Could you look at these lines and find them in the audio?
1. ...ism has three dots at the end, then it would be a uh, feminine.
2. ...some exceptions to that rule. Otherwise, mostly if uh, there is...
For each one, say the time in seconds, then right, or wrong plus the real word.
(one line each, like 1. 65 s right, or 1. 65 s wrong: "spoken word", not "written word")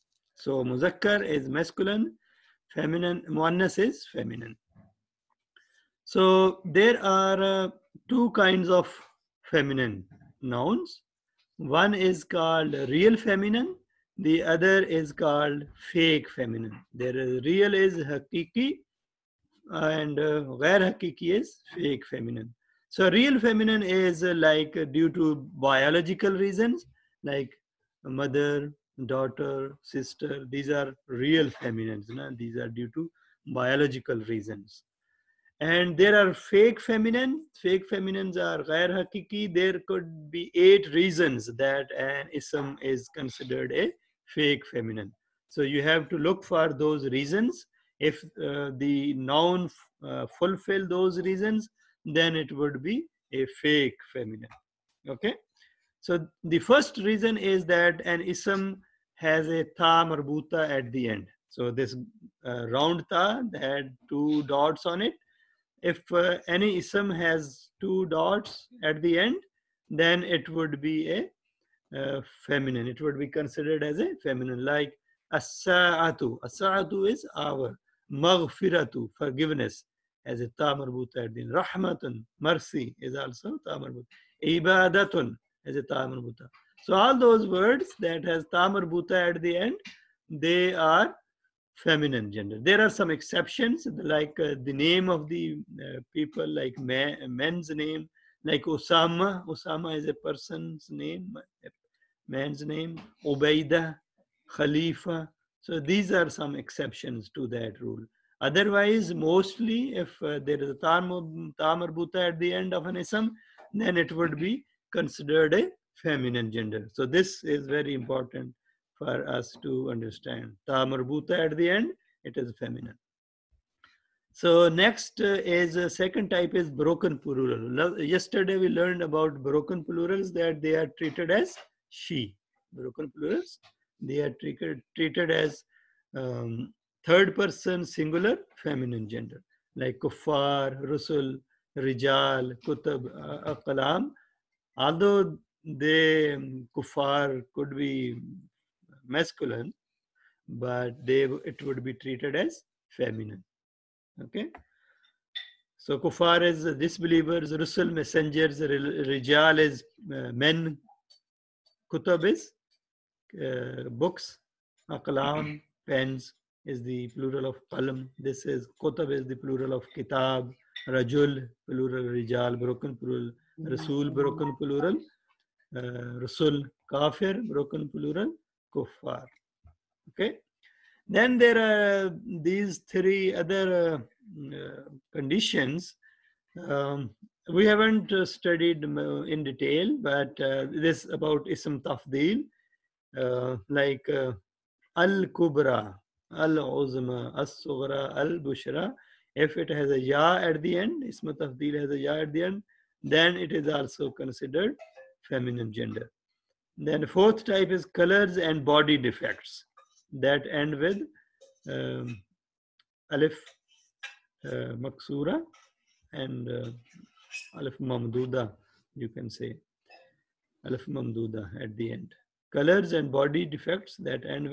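1. 66 s wrong: "two", not "three"
2. 106 s right.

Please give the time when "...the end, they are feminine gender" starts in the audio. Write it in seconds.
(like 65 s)
89 s.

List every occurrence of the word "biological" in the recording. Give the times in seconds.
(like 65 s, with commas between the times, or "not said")
25 s, 33 s.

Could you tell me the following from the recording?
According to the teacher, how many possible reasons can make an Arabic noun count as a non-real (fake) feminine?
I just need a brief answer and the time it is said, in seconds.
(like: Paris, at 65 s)
8, at 40 s.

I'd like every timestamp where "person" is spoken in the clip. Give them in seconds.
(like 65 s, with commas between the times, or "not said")
100 s, 137 s.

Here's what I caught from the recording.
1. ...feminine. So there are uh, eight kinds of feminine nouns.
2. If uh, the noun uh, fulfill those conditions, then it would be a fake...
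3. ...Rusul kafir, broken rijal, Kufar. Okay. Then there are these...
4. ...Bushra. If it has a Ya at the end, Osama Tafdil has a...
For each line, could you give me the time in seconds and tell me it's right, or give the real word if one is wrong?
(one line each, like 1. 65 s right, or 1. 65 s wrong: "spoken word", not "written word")
1. 4 s wrong: "two", not "eight"
2. 48 s wrong: "reasons", not "conditions"
3. 176 s wrong: "plural", not "rijal"
4. 198 s wrong: "Ism", not "Osama".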